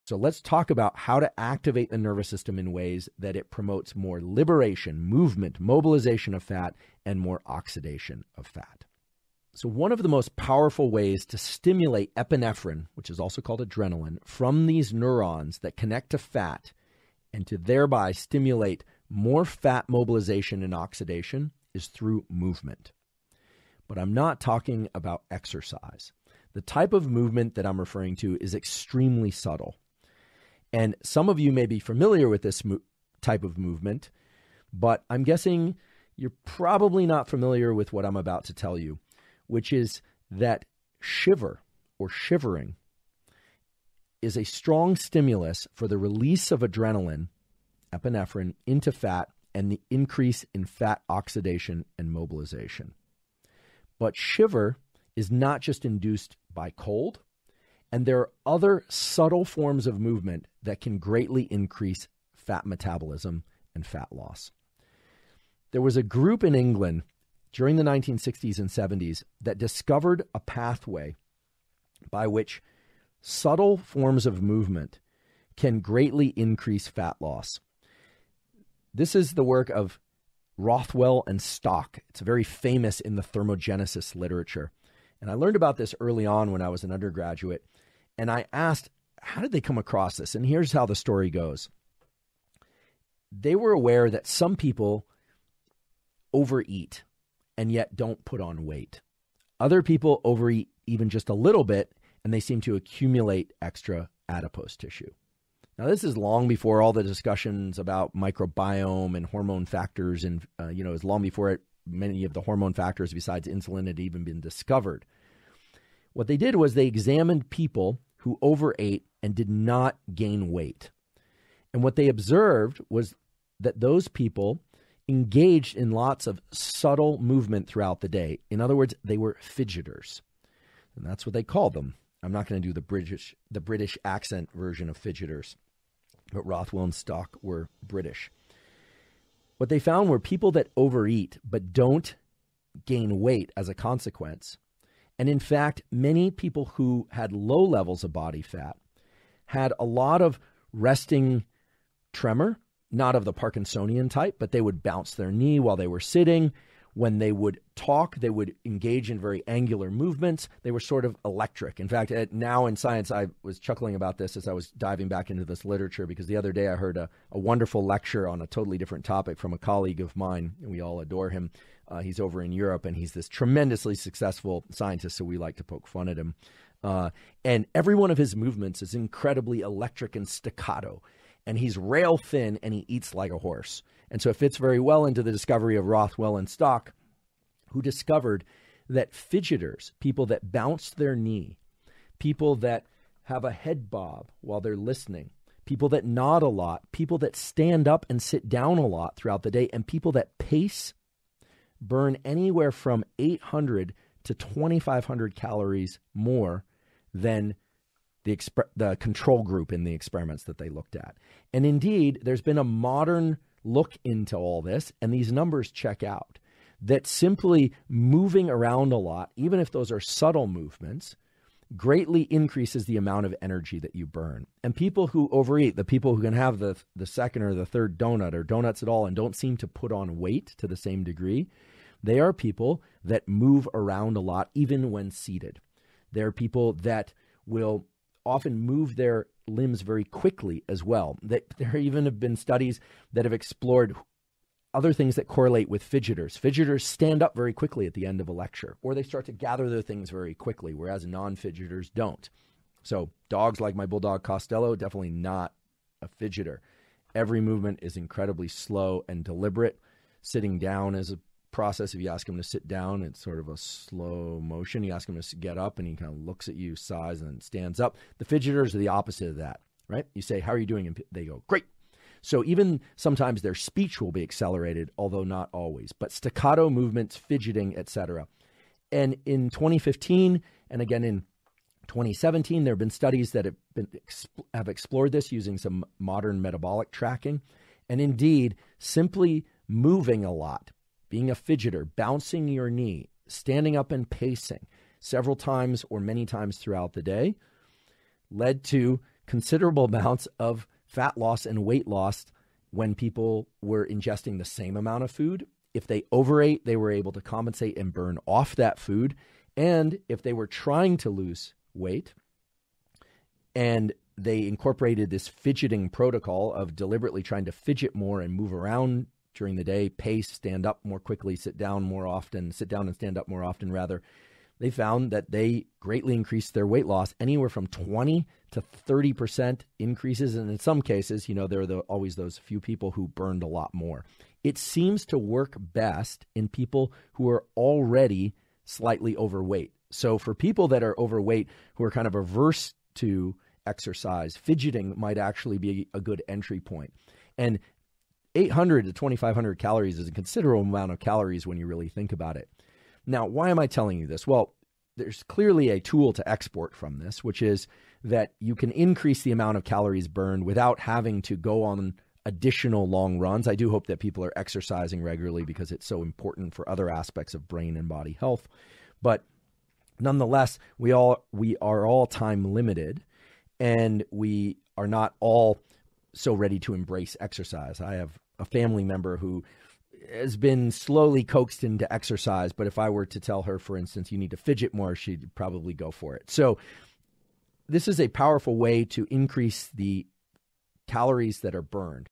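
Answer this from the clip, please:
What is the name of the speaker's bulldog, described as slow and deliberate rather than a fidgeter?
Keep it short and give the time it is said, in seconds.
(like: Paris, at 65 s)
Costello, at 254 s.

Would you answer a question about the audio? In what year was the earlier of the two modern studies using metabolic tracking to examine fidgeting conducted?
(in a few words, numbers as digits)
2015.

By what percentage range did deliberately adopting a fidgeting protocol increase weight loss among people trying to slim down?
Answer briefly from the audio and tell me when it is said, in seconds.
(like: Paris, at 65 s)
20 to 30%, at 327 s.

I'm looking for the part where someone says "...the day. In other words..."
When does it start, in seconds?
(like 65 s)
128 s.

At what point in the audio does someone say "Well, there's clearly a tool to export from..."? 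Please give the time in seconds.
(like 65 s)
354 s.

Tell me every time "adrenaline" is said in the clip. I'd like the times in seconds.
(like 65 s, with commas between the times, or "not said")
13 s, 46 s.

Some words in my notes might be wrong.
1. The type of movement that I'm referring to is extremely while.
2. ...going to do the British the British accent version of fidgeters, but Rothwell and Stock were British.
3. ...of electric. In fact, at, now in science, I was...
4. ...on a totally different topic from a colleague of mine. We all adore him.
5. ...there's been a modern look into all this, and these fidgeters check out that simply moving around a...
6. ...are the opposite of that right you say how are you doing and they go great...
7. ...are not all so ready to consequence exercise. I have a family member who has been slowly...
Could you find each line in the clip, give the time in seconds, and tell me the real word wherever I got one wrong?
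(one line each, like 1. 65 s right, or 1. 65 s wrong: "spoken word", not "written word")
1. 26 s wrong: "subtle", not "while"
2. 132 s right
3. 161 s right
4. 168 s right
5. 212 s wrong: "numbers", not "fidgeters"
6. 268 s right
7. 374 s wrong: "embrace", not "consequence".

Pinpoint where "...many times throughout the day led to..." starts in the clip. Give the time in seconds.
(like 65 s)
295 s.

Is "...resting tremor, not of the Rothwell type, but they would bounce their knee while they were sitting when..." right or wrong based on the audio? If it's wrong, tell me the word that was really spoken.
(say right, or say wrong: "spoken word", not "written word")
wrong: "Parkinsonian", not "Rothwell".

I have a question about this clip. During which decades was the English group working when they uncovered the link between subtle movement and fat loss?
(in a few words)
1960s and 70s.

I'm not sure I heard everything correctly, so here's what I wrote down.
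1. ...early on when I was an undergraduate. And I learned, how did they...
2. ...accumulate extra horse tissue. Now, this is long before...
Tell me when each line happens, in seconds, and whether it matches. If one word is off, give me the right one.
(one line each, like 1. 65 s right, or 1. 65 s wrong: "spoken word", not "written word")
1. 85 s wrong: "asked", not "learned"
2. 102 s wrong: "adipose", not "horse".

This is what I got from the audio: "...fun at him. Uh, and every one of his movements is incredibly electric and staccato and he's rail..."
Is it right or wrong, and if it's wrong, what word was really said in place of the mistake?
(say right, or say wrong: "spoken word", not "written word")
right.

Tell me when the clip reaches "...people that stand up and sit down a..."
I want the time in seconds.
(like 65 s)
196 s.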